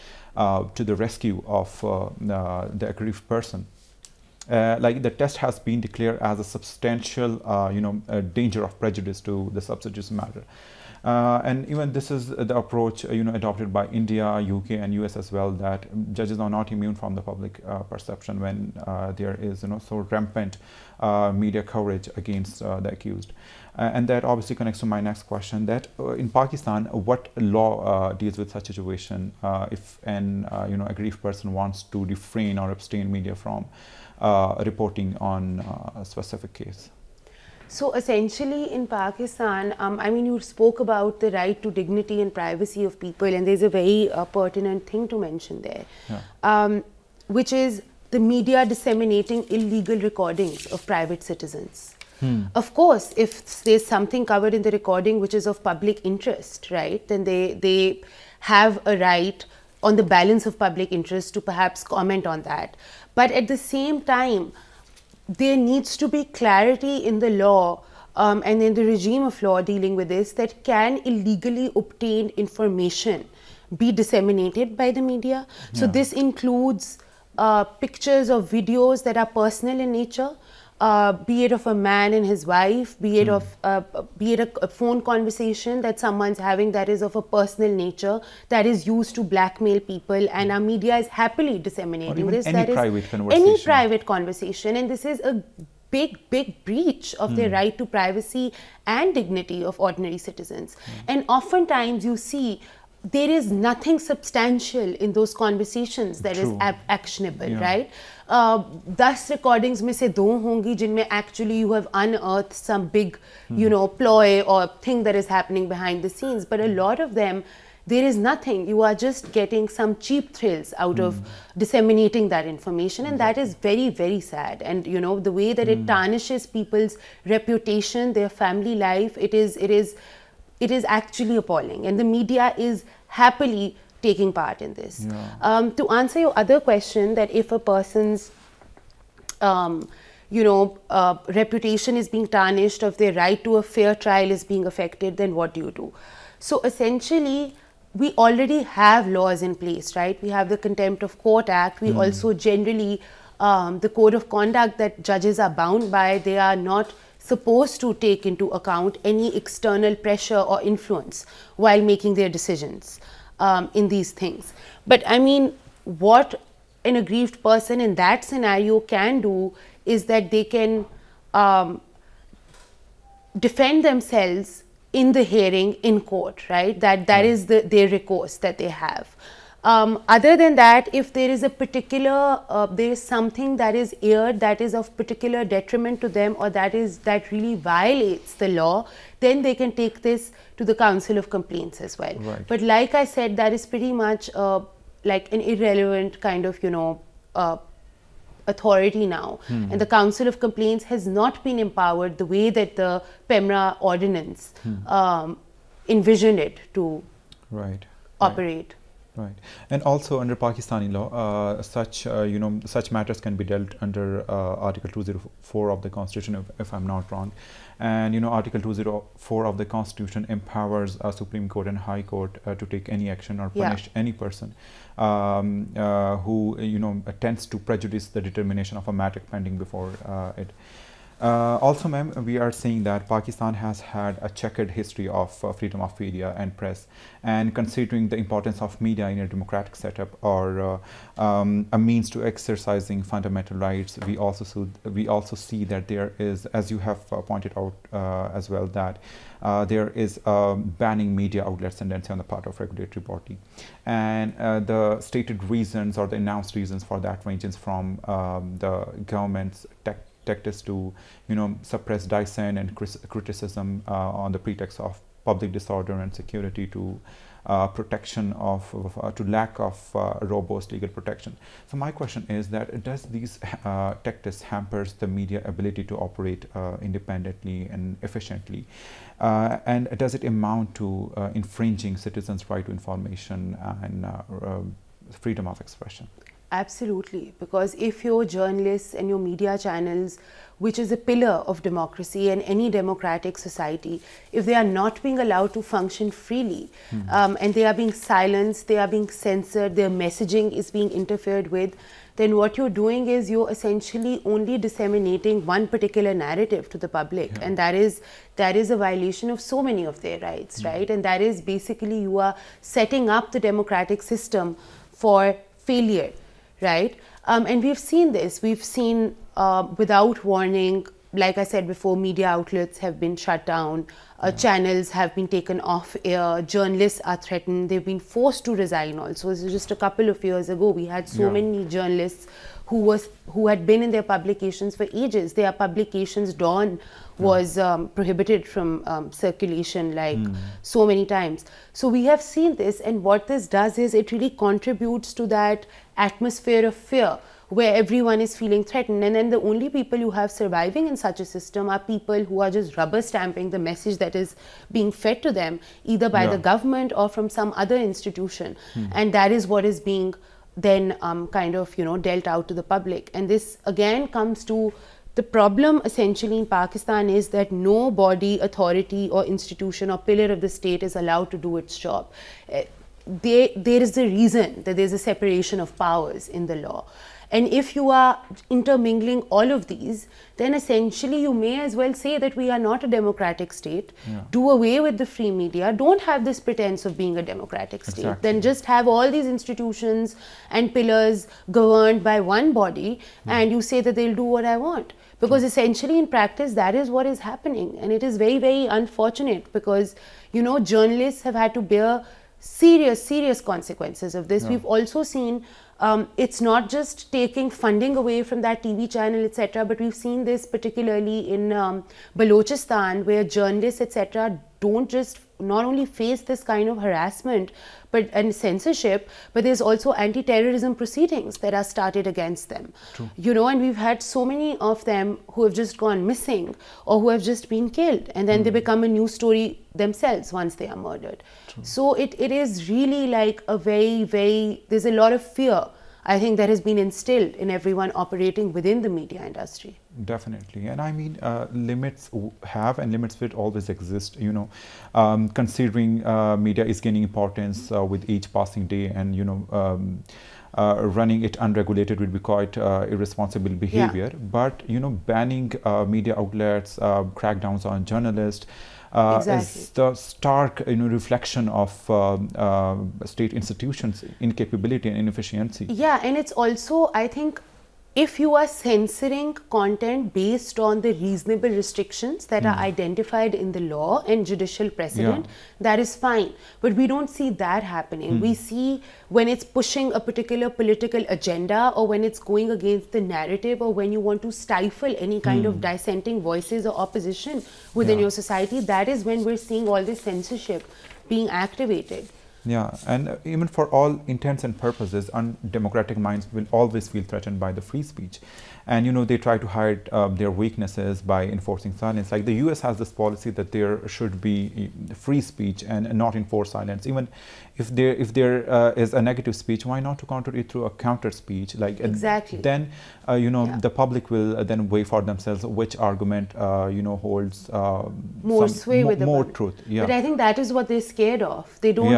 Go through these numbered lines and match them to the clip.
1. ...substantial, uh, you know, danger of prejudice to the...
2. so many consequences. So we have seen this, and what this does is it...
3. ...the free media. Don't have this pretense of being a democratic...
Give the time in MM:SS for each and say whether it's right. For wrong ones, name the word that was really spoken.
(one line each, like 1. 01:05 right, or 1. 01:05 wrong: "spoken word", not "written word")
1. 00:06 right
2. 05:40 wrong: "times", not "consequences"
3. 06:24 right.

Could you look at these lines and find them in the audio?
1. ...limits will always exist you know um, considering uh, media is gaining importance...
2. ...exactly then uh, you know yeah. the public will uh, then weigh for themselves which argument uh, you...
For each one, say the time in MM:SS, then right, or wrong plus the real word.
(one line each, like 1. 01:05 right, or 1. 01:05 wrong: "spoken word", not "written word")
1. 07:22 right
2. 08:31 right.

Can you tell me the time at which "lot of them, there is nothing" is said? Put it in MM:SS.
01:56.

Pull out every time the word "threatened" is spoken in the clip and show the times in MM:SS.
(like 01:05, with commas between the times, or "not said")
05:27, 05:48, 08:17.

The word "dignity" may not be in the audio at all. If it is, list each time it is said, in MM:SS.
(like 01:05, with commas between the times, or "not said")
00:41, 01:39.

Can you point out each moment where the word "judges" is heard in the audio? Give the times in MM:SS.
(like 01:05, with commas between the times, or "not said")
00:16, 02:35.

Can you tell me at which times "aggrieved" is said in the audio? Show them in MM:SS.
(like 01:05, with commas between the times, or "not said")
00:02, 00:30, 02:47.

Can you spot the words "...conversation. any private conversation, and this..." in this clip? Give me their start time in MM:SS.
01:33.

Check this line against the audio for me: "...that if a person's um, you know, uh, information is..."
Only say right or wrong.
wrong.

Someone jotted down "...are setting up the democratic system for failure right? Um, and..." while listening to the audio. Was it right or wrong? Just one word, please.
right.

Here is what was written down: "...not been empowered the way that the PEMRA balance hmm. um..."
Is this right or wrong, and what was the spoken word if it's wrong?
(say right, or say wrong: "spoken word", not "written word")
wrong: "ordinance", not "balance".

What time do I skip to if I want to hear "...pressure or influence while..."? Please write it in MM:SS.
02:40.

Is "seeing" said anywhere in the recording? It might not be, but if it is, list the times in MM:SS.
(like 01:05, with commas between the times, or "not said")
03:52, 08:09.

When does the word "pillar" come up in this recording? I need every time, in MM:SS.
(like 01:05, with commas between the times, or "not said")
04:50, 06:09, 06:30.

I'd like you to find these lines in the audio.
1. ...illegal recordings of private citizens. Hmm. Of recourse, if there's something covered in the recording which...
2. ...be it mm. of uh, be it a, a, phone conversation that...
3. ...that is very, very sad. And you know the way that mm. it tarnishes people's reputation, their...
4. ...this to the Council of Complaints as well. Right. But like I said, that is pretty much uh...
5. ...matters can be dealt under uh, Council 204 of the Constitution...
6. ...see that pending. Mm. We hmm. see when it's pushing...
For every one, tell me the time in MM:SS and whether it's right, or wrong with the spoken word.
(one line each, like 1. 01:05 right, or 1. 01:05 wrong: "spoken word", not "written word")
1. 00:49 wrong: "course", not "recourse"
2. 01:22 right
3. 02:03 right
4. 03:10 right
5. 03:32 wrong: "Article", not "Council"
6. 07:57 wrong: "happening", not "pending".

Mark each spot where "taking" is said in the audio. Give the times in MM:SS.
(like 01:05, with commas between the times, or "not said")
02:14, 06:47.